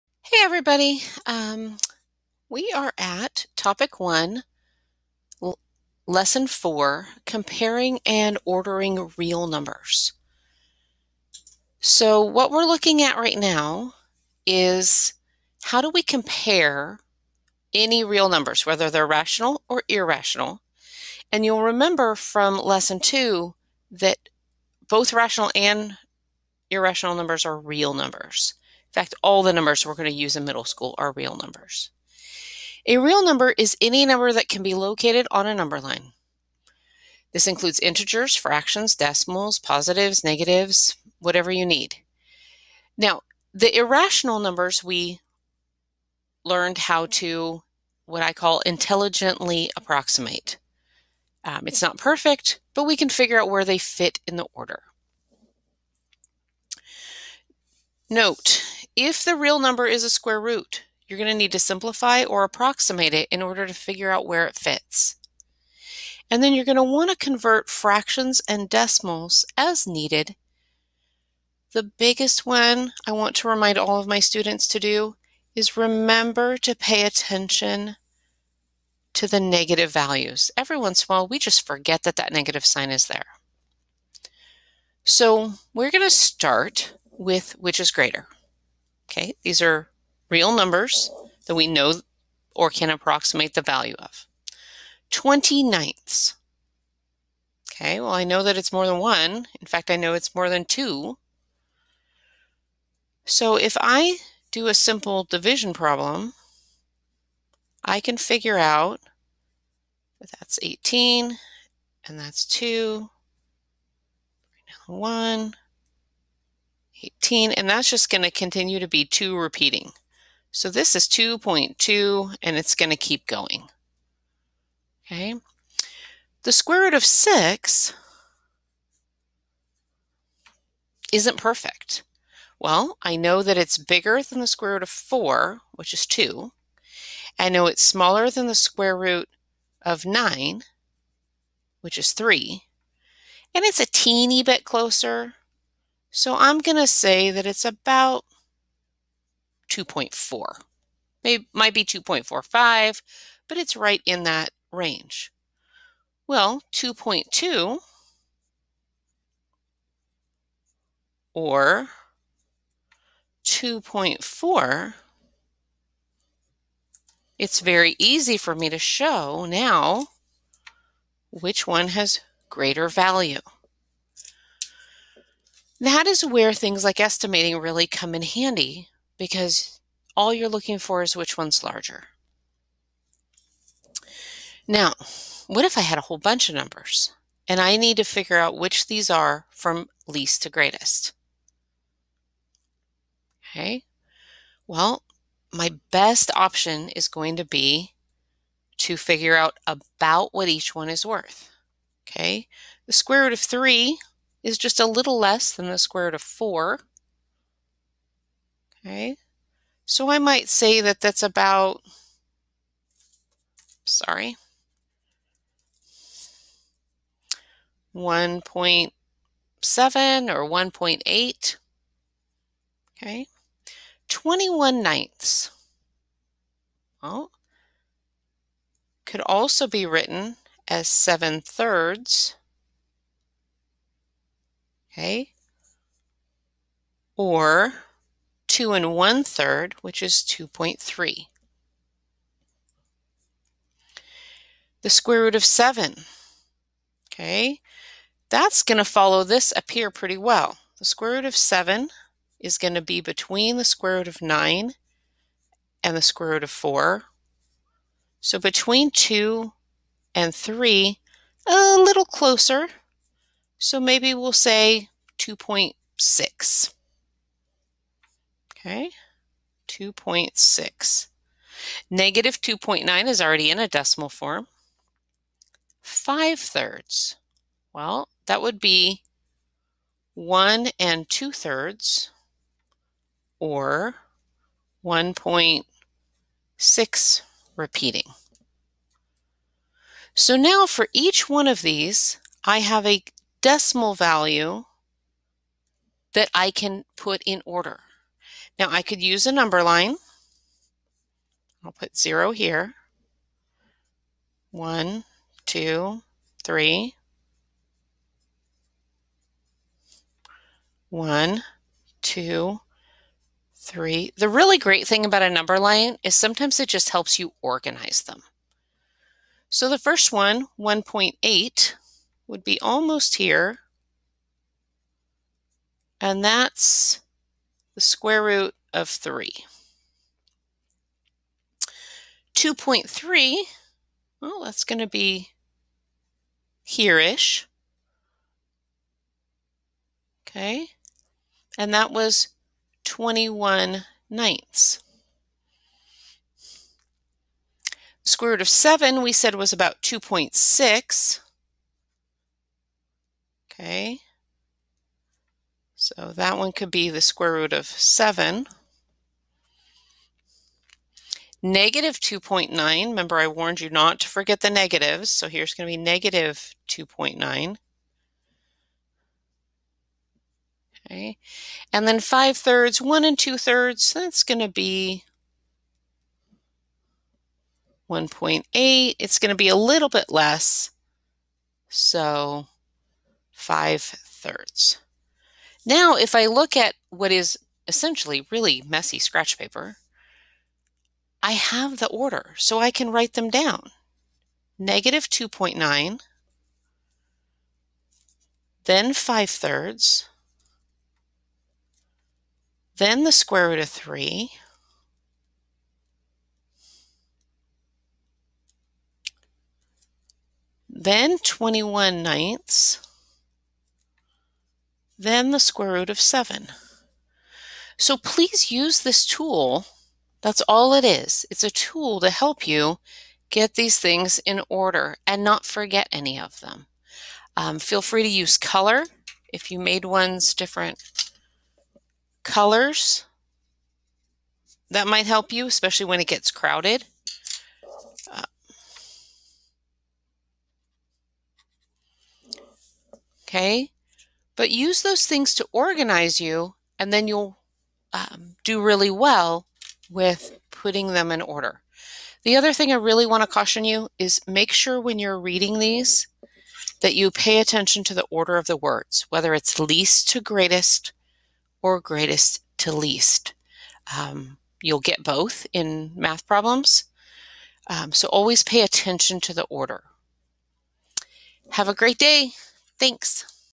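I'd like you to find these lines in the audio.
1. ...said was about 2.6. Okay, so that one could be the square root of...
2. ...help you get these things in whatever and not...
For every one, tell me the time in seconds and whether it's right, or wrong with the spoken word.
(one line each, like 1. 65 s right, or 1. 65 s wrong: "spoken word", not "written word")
1. 349 s right
2. 422 s wrong: "order", not "whatever".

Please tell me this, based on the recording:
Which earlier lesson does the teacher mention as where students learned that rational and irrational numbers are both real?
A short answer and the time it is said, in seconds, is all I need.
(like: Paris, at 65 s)
lesson two, at 22 s.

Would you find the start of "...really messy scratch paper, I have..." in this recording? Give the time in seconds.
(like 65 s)
388 s.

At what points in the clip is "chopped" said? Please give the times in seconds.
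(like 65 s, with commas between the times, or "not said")
not said.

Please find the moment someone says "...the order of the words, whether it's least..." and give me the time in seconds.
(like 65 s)
457 s.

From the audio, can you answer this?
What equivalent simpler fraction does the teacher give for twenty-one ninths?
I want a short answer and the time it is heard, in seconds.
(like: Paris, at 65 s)
7 thirds, at 230 s.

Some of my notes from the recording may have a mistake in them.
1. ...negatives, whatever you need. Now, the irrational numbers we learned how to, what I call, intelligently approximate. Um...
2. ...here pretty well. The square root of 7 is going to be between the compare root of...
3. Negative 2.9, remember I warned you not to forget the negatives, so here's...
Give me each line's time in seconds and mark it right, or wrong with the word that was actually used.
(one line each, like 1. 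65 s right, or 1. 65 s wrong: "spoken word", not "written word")
1. 40 s right
2. 249 s wrong: "square", not "compare"
3. 361 s right.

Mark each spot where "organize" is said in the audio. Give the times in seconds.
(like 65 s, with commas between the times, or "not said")
317 s, 445 s.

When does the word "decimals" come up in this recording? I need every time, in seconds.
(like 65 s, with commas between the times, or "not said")
38 s, 68 s, 273 s, 293 s.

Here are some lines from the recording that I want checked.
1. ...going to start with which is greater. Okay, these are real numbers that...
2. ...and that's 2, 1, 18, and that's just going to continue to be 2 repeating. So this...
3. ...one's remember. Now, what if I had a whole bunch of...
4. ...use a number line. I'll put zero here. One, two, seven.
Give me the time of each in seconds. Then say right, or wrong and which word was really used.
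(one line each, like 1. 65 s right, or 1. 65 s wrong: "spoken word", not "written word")
1. 85 s right
2. 112 s right
3. 181 s wrong: "larger", not "remember"
4. 299 s wrong: "three", not "seven".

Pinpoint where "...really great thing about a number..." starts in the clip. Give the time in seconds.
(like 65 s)
314 s.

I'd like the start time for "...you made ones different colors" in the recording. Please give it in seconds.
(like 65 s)
429 s.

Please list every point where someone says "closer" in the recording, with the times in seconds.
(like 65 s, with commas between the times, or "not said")
144 s, 262 s.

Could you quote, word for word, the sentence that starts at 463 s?
Um, you'll get both in math problems.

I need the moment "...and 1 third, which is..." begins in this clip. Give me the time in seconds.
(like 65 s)
238 s.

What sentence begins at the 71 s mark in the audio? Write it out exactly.
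The biggest one I want to remind all of my students to do is remember to pay attention to the negative values.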